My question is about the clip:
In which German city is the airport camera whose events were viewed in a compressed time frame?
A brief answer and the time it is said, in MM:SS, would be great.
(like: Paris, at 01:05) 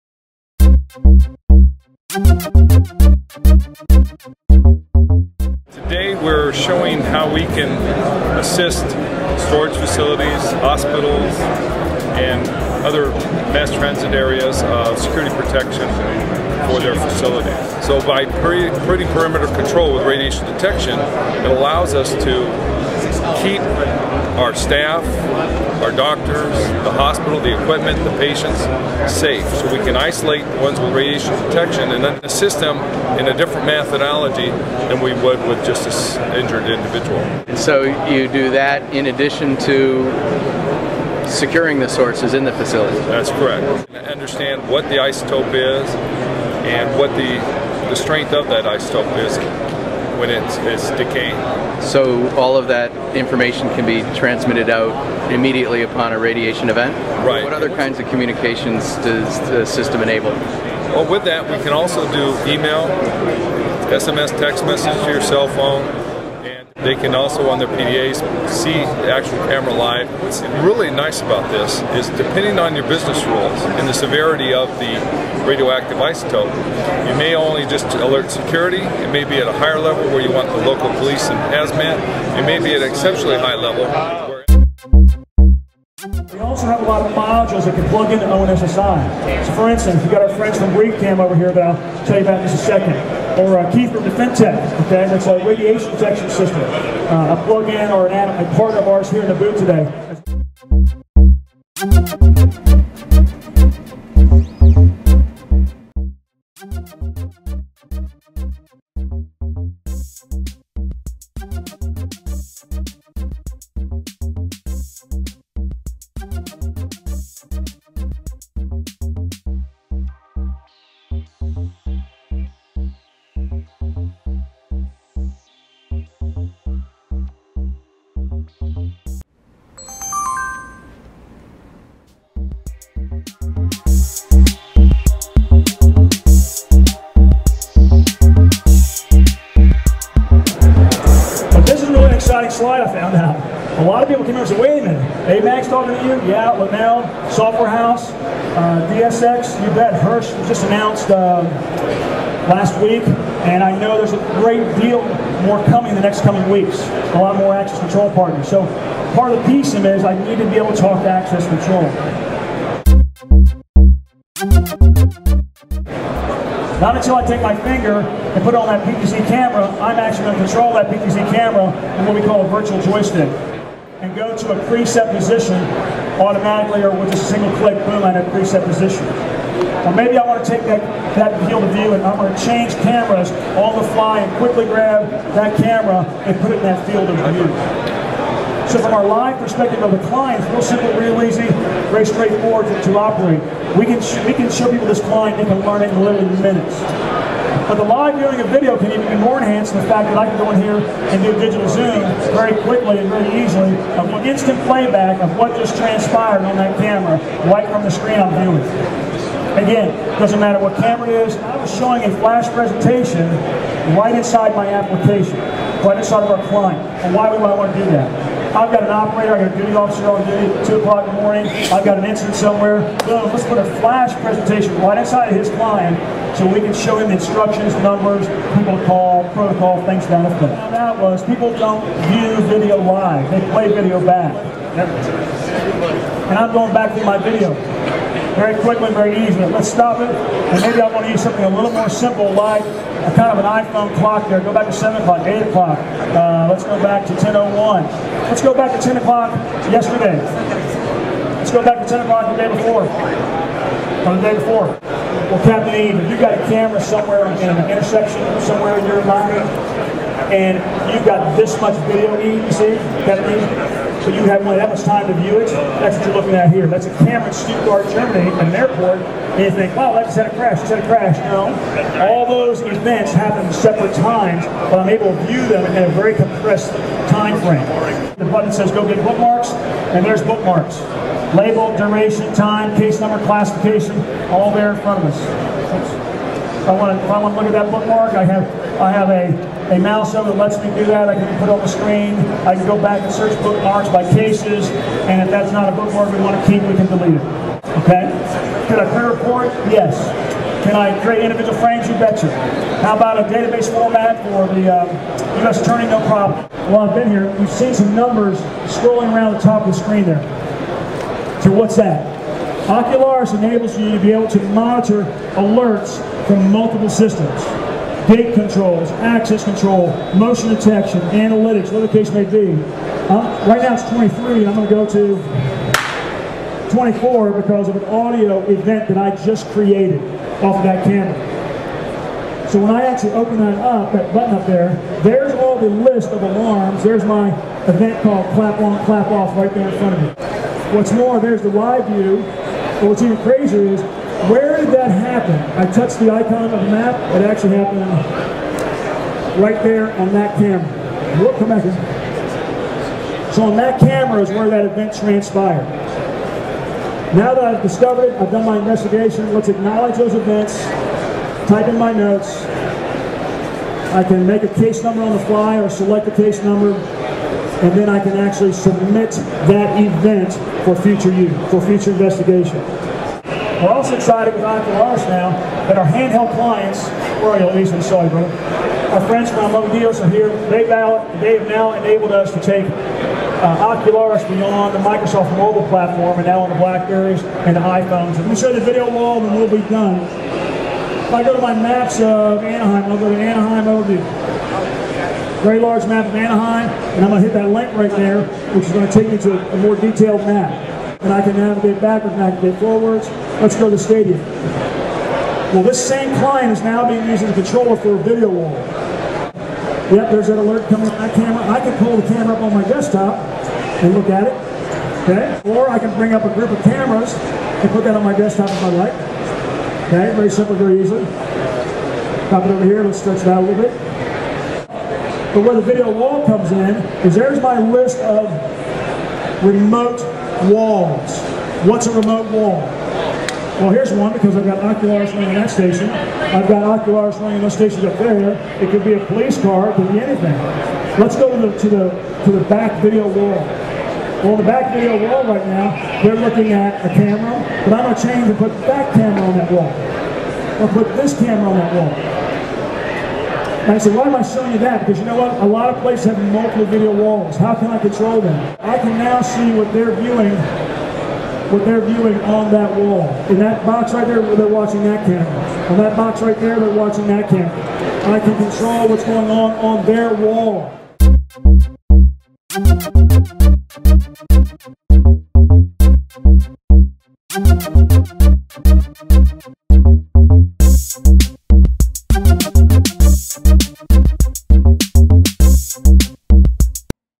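Stuttgart, at 04:27.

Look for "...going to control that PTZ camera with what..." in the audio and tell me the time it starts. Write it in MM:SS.
02:50.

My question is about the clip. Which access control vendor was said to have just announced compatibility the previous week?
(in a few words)
Hirsch.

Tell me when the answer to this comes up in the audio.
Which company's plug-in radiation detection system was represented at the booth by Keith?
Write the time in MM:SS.
01:34.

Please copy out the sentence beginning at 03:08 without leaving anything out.
So from our live perspective of the client, it's real simple, real easy, very straightforward to, to operate.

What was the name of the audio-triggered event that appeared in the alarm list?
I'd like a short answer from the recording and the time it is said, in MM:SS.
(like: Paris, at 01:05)
clap on, clap off, at 05:38.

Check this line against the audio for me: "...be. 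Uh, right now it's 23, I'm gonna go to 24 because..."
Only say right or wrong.
right.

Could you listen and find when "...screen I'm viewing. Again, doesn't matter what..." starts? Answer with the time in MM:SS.
03:27.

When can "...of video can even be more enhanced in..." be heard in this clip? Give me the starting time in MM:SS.
03:18.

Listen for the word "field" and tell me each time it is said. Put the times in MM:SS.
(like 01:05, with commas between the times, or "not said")
03:01, 03:06.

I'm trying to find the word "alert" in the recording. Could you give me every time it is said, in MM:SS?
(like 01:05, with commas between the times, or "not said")
01:17, 05:15, 06:50.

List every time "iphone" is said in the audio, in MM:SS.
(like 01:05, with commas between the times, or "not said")
04:03, 06:27.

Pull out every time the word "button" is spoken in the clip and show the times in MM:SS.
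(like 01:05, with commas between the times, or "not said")
04:38, 05:34.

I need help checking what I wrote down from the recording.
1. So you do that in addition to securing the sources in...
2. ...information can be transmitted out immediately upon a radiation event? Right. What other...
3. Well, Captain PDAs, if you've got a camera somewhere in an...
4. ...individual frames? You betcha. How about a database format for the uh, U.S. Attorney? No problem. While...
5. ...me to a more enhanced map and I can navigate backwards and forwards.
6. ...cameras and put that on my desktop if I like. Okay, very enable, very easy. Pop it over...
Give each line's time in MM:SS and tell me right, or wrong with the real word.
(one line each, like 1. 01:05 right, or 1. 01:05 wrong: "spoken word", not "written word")
1. 00:37 right
2. 00:53 right
3. 04:15 wrong: "Eve", not "PDAs"
4. 05:01 right
5. 06:39 wrong: "detailed", not "enhanced"
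6. 06:56 wrong: "simple", not "enable".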